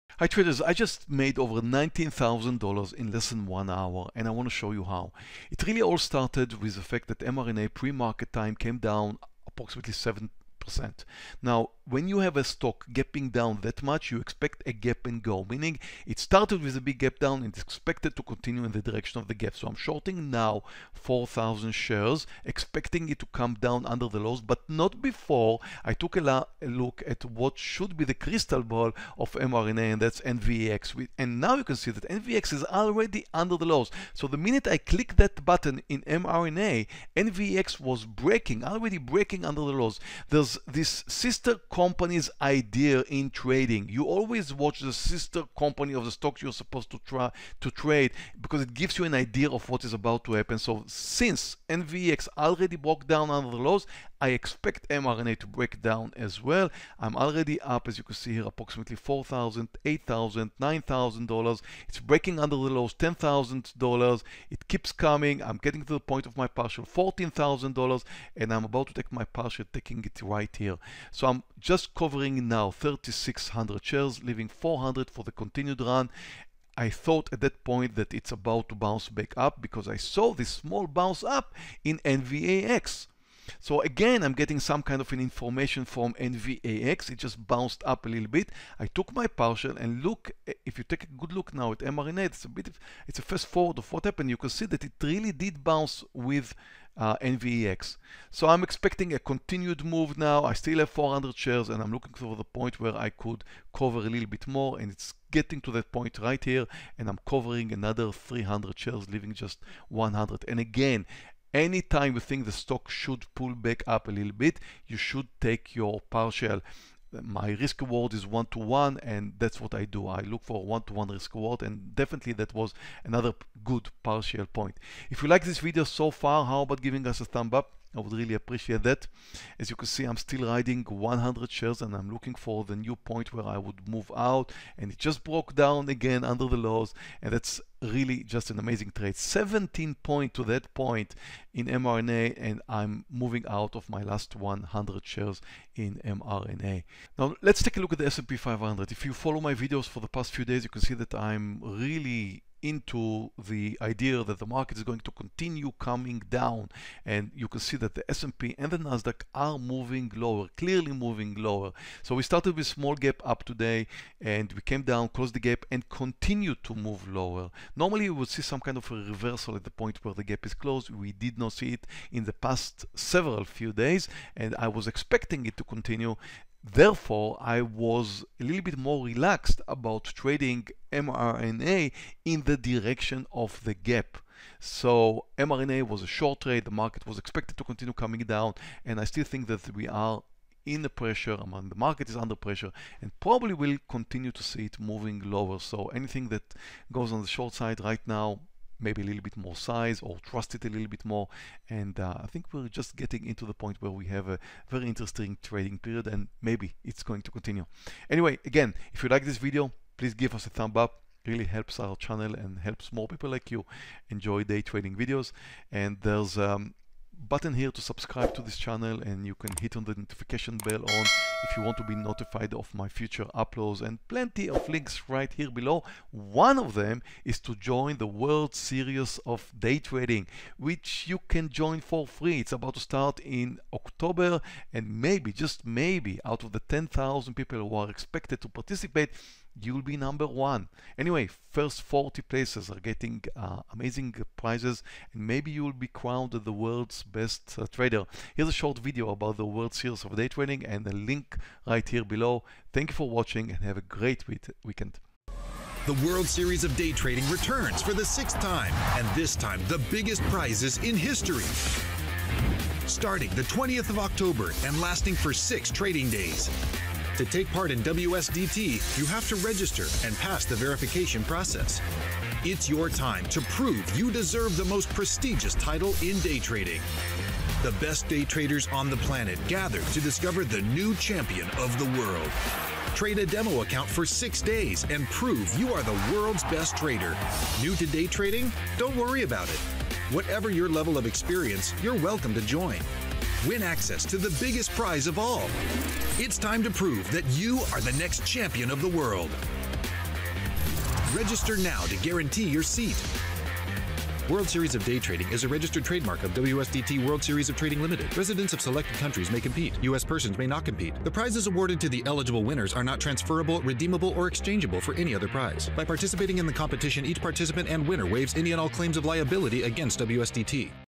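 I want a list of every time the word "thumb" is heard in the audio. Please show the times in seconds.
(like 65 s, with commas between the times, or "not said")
127 s, 210 s.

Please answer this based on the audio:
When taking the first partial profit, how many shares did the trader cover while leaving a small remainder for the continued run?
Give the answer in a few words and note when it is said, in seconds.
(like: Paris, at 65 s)
3,600, at 72 s.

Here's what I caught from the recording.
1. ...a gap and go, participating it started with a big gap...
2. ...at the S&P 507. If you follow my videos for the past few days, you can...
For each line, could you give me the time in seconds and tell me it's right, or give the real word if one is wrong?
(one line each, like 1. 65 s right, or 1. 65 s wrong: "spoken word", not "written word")
1. 14 s wrong: "meaning", not "participating"
2. 147 s wrong: "500", not "507".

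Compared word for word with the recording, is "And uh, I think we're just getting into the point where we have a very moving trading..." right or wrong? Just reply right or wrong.
wrong.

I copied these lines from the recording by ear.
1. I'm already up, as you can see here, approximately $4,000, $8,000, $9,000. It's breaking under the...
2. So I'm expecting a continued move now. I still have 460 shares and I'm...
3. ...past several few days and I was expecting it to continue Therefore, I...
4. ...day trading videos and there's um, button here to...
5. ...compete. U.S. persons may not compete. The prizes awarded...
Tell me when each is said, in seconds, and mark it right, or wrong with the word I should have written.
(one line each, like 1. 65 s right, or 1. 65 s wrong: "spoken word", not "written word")
1. 56 s right
2. 98 s wrong: "400", not "460"
3. 172 s right
4. 214 s right
5. 309 s right.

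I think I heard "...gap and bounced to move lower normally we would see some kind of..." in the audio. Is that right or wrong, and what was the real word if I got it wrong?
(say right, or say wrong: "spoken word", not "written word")
wrong: "continued", not "bounced".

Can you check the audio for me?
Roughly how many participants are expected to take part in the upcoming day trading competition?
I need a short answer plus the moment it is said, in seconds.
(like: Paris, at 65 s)
10,000, at 236 s.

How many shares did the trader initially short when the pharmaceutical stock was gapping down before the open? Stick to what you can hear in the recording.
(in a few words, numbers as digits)
4,000.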